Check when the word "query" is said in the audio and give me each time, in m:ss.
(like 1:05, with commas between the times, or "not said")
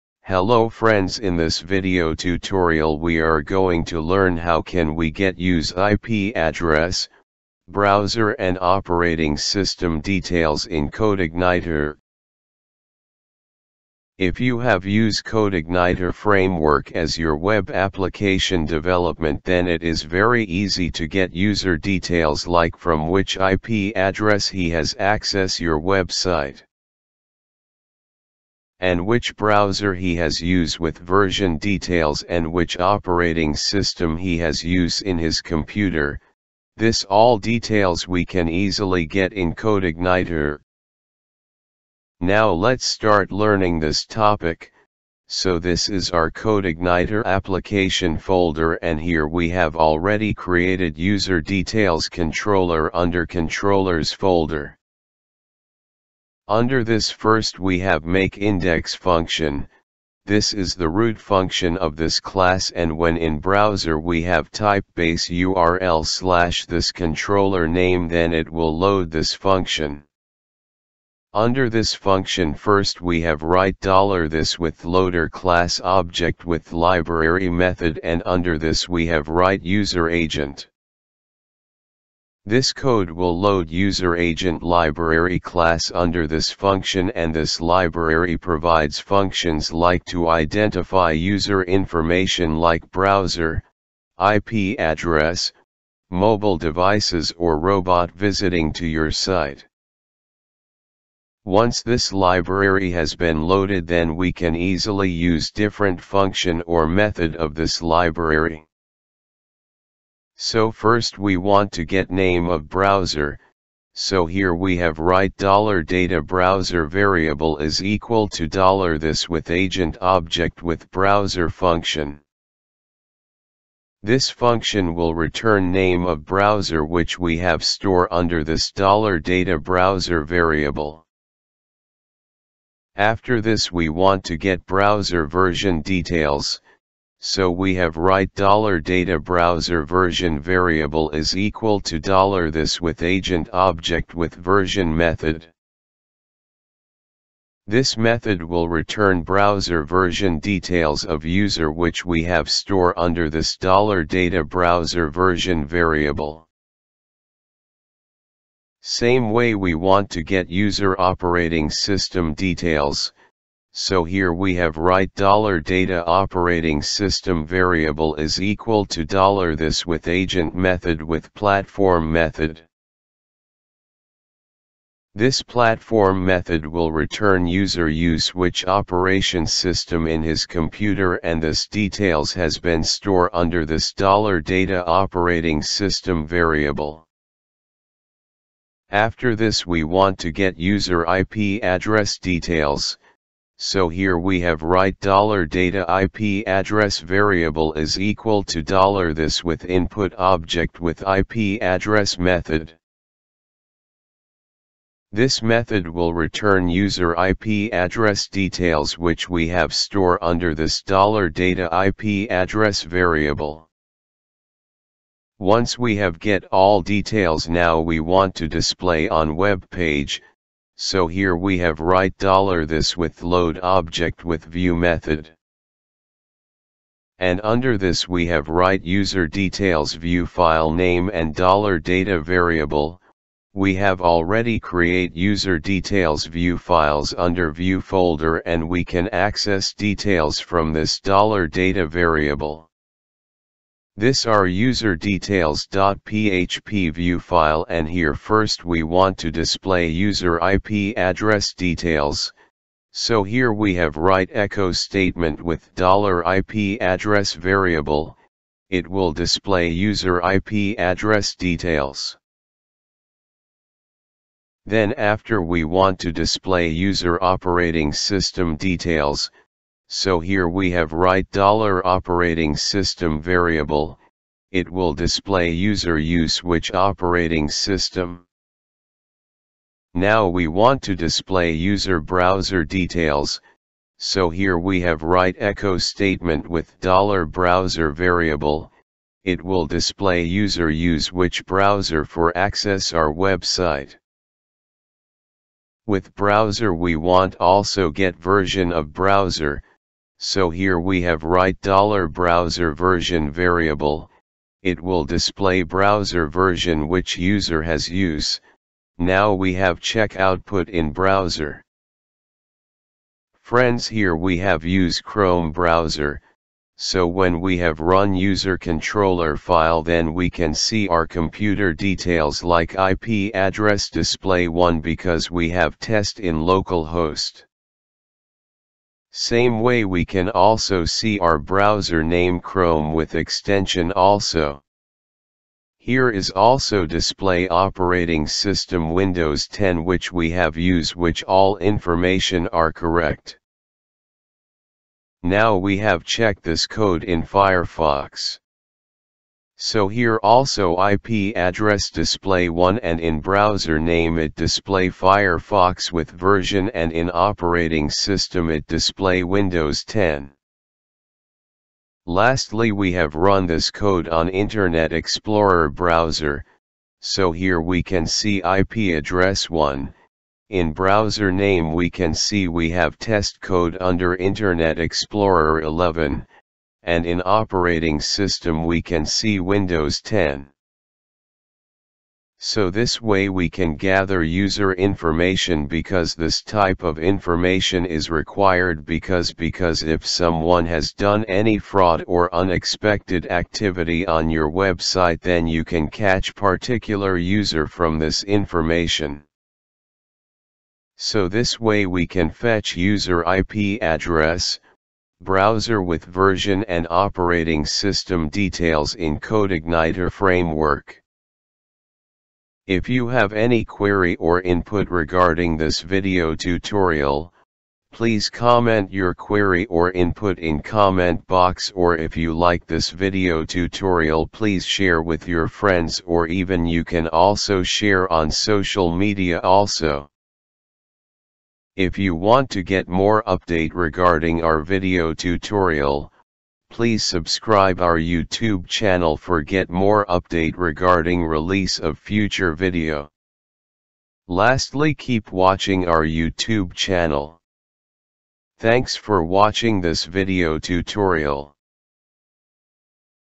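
6:53, 6:59.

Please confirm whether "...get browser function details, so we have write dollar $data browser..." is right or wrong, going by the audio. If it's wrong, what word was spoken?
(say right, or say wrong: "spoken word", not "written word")
wrong: "version", not "function".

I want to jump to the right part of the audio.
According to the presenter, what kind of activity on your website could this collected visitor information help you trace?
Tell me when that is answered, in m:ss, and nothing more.
6:31.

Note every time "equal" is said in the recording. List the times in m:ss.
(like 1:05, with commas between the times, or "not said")
1:57, 2:21, 2:48, 3:17.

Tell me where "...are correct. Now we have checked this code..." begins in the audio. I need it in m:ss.
5:42.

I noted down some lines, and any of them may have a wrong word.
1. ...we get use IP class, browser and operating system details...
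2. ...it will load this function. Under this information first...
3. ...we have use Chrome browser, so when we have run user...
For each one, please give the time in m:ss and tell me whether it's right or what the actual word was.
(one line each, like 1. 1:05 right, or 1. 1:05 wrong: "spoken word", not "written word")
1. 0:04 wrong: "address", not "class"
2. 1:08 wrong: "function", not "information"
3. 5:14 right.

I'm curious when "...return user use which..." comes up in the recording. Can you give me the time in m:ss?
2:56.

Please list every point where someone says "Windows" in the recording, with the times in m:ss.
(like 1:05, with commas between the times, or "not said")
5:38, 5:59, 6:19.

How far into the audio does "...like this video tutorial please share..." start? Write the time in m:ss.
7:02.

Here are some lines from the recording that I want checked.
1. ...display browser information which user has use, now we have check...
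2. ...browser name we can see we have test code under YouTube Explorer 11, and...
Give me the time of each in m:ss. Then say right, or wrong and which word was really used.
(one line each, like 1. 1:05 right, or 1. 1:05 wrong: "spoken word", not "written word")
1. 5:05 wrong: "version", not "information"
2. 6:10 wrong: "Internet", not "YouTube".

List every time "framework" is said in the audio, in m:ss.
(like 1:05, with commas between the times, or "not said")
0:16, 6:50.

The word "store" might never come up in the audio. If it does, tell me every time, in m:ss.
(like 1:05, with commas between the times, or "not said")
2:07, 2:32, 3:02, 3:29.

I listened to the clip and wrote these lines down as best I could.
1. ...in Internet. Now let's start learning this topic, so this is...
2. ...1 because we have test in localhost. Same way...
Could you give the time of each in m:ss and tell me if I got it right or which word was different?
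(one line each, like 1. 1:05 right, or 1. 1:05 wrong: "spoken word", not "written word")
1. 0:39 wrong: "CodeIgniter", not "Internet"
2. 5:24 right.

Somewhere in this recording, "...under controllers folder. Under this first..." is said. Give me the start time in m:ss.
0:52.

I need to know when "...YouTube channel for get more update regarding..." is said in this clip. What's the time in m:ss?
7:17.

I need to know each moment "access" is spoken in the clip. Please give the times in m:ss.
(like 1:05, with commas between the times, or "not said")
0:24, 3:59, 4:52.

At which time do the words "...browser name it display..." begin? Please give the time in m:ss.
5:53.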